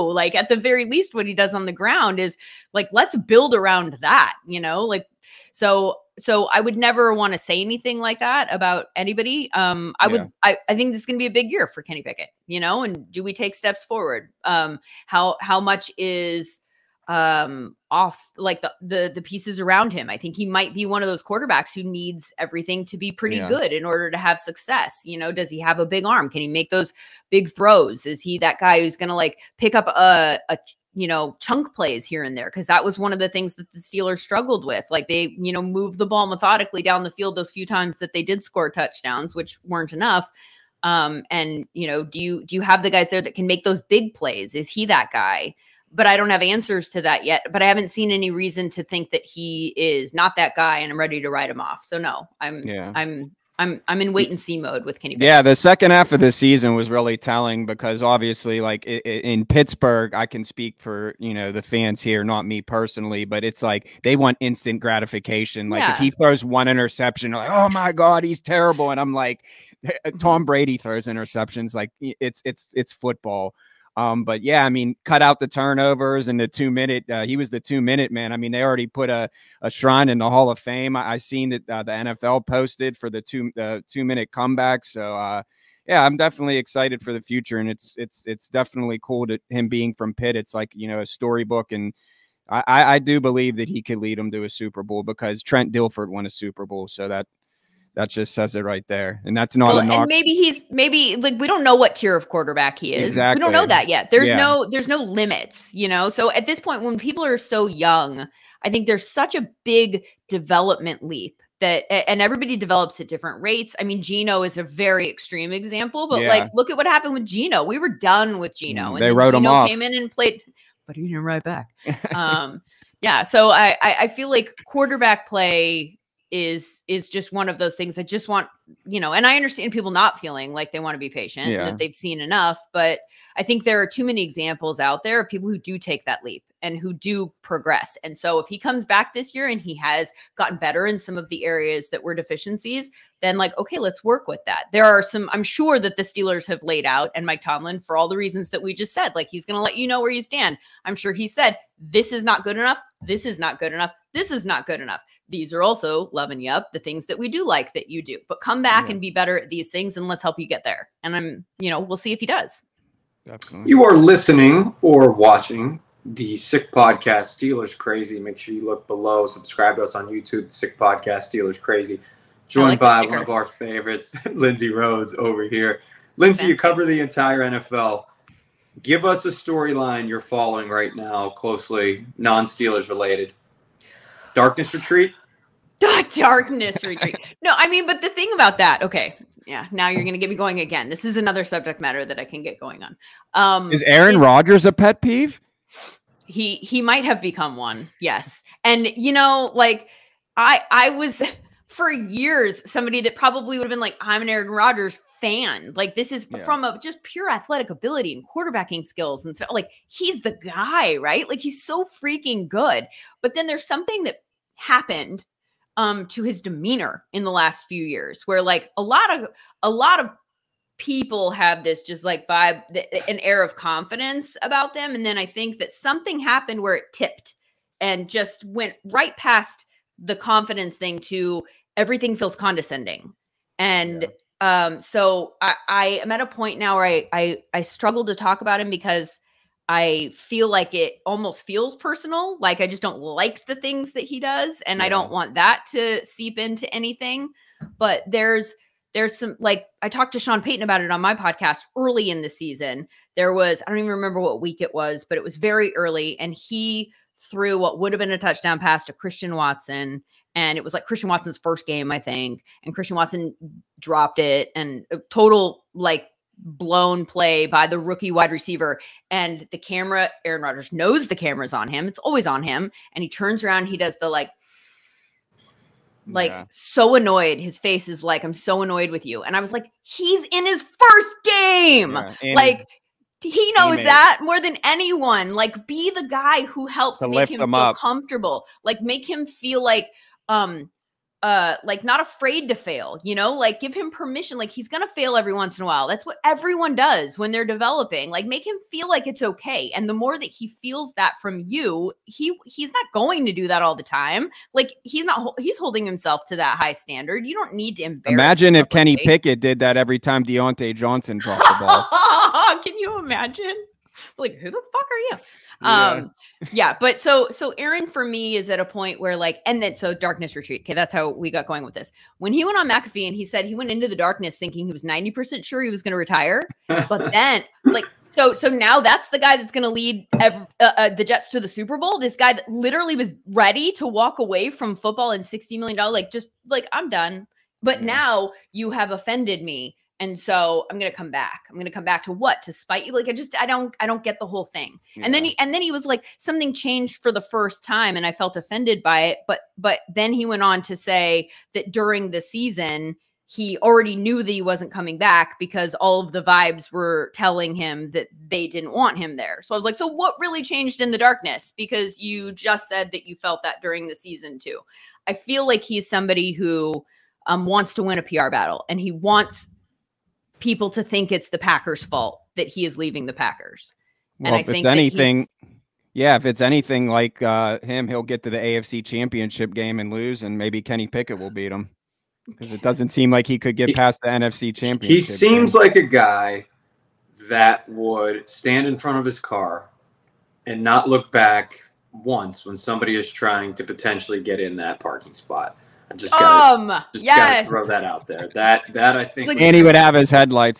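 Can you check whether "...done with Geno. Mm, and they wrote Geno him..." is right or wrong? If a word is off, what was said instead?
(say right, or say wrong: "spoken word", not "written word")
right.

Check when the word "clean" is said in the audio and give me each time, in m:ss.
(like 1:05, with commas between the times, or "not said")
not said.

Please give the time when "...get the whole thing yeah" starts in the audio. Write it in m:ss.
5:44.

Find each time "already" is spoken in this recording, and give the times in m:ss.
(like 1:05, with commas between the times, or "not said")
1:18, 5:53.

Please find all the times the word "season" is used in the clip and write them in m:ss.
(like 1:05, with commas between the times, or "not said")
0:56, 4:12, 5:52, 6:03.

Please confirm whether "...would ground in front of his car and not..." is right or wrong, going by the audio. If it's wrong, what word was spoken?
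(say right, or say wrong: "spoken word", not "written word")
wrong: "stand", not "ground".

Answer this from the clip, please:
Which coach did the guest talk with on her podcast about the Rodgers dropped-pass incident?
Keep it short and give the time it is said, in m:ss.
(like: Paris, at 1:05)
Sean Payton, at 4:10.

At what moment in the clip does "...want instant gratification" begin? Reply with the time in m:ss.
1:04.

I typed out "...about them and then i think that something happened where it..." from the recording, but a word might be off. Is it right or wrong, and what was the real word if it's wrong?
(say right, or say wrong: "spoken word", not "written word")
right.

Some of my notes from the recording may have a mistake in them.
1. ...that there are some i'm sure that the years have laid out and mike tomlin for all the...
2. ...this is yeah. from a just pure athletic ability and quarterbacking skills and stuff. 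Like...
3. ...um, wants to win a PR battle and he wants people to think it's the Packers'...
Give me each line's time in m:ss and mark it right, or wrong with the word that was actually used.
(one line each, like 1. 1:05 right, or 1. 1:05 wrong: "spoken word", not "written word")
1. 2:24 wrong: "steelers", not "years"
2. 3:25 right
3. 6:07 right.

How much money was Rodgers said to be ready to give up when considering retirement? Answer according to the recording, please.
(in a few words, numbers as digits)
60 million dollars.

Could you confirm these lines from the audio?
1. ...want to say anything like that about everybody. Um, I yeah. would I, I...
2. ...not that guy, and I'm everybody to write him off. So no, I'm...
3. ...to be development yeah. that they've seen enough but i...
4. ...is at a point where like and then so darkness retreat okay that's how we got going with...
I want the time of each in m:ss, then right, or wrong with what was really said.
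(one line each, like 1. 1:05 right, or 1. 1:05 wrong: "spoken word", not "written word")
1. 0:07 wrong: "anybody", not "everybody"
2. 0:50 wrong: "ready", not "everybody"
3. 2:10 wrong: "patient", not "development"
4. 5:18 right.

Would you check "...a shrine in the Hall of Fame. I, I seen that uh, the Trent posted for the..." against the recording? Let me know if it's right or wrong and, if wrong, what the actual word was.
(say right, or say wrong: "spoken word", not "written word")
wrong: "NFL", not "Trent".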